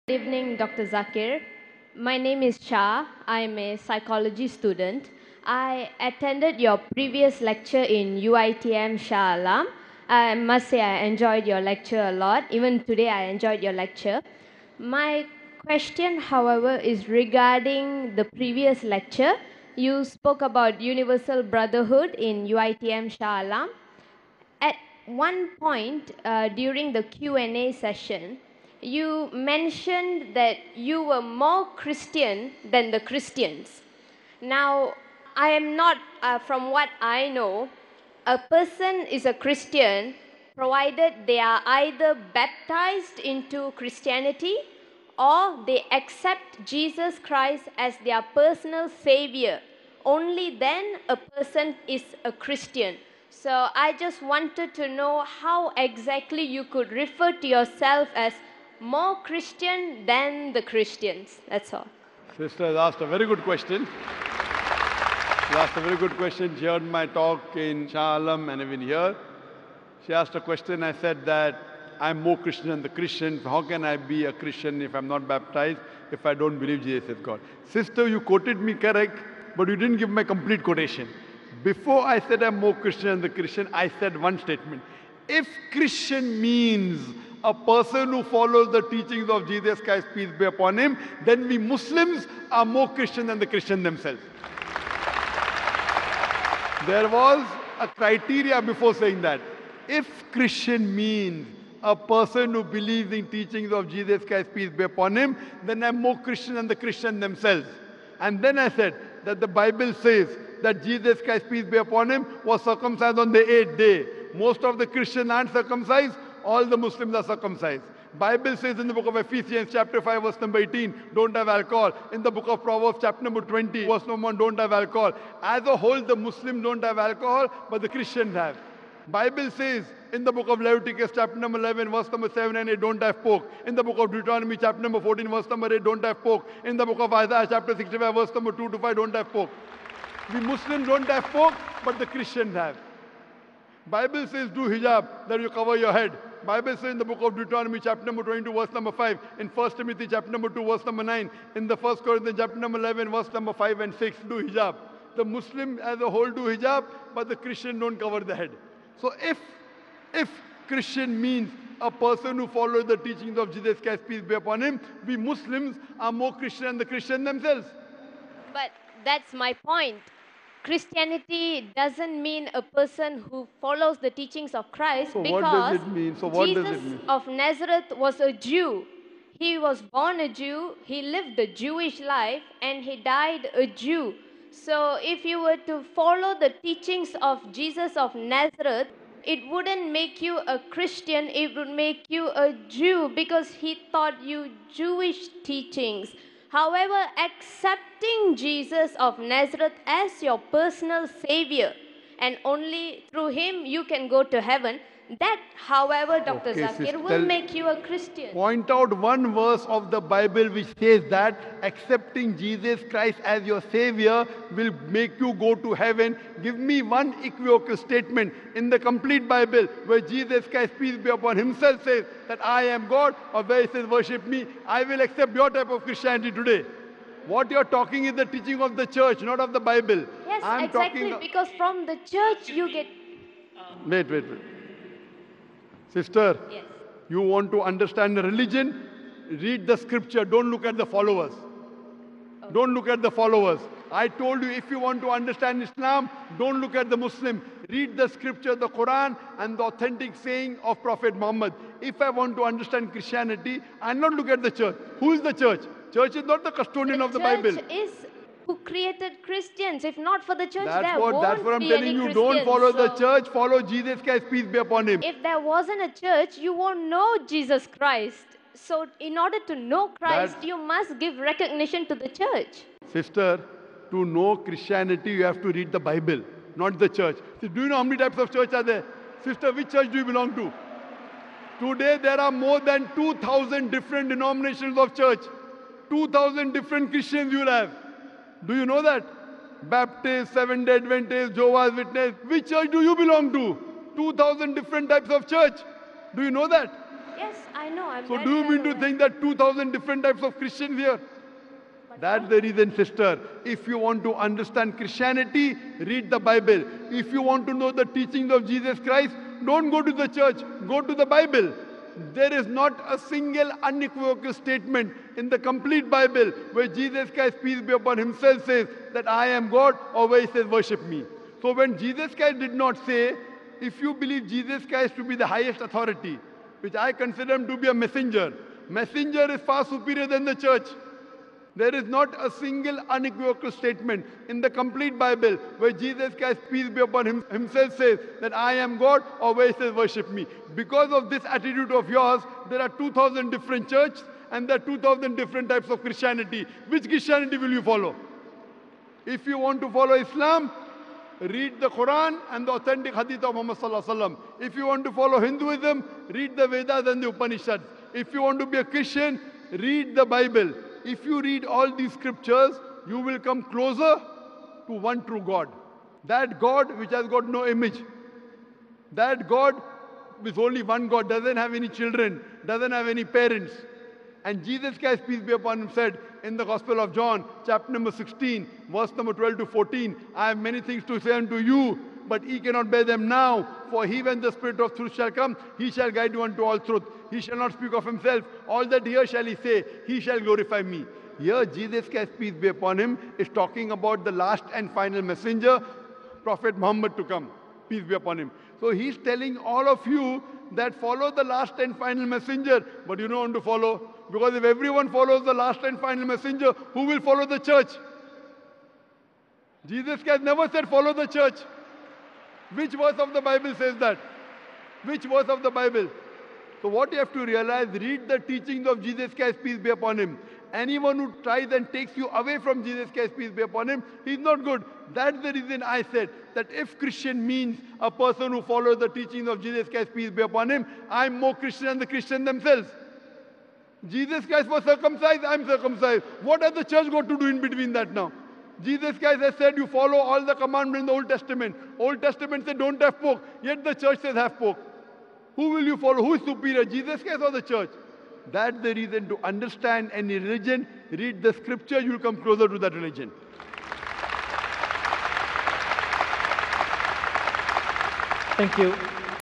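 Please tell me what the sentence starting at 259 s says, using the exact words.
If not for the church, that's there what, won't That's what I'm telling you.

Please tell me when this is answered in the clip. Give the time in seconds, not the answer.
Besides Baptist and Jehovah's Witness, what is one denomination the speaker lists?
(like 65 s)
290 s.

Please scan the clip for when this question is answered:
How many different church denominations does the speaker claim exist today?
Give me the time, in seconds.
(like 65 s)
282 s.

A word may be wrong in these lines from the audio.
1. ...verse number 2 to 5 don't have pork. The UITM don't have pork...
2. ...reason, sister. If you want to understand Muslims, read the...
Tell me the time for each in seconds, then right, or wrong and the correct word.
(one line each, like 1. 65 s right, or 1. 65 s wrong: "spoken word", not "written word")
1. 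138 s wrong: "Muslims", not "UITM"
2. 302 s wrong: "Christianity", not "Muslims".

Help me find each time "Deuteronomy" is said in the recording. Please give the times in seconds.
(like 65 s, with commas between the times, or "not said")
134 s, 147 s.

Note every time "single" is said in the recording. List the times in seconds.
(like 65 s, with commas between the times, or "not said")
312 s, 332 s.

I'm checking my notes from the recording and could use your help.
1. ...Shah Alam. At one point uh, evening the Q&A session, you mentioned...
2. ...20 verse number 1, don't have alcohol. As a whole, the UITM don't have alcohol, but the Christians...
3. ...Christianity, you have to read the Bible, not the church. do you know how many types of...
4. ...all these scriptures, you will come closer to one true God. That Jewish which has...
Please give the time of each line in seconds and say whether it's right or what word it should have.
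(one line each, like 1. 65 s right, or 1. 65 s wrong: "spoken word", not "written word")
1. 23 s wrong: "during", not "evening"
2. 123 s wrong: "Muslims", not "UITM"
3. 274 s right
4. 361 s wrong: "God", not "Jewish".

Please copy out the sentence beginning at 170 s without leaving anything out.
Christianity doesn't mean a person who follows the teachings of Christ so because so Jesus of Nazareth was a Jew.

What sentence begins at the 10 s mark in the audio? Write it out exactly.
I must say I enjoyed your lecture a lot.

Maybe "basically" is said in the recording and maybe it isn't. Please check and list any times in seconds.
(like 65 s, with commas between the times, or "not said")
not said.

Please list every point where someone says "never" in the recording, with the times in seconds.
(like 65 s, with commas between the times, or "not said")
410 s.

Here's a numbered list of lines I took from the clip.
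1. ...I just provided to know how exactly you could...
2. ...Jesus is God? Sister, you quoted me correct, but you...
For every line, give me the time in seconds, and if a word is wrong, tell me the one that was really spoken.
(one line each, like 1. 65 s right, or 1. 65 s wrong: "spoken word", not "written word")
1. 53 s wrong: "wanted", not "provided"
2. 76 s right.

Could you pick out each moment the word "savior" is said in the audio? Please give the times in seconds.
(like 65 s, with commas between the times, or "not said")
48 s, 201 s, 213 s.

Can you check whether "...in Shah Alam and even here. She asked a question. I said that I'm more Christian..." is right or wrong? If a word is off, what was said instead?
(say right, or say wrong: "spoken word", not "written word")
right.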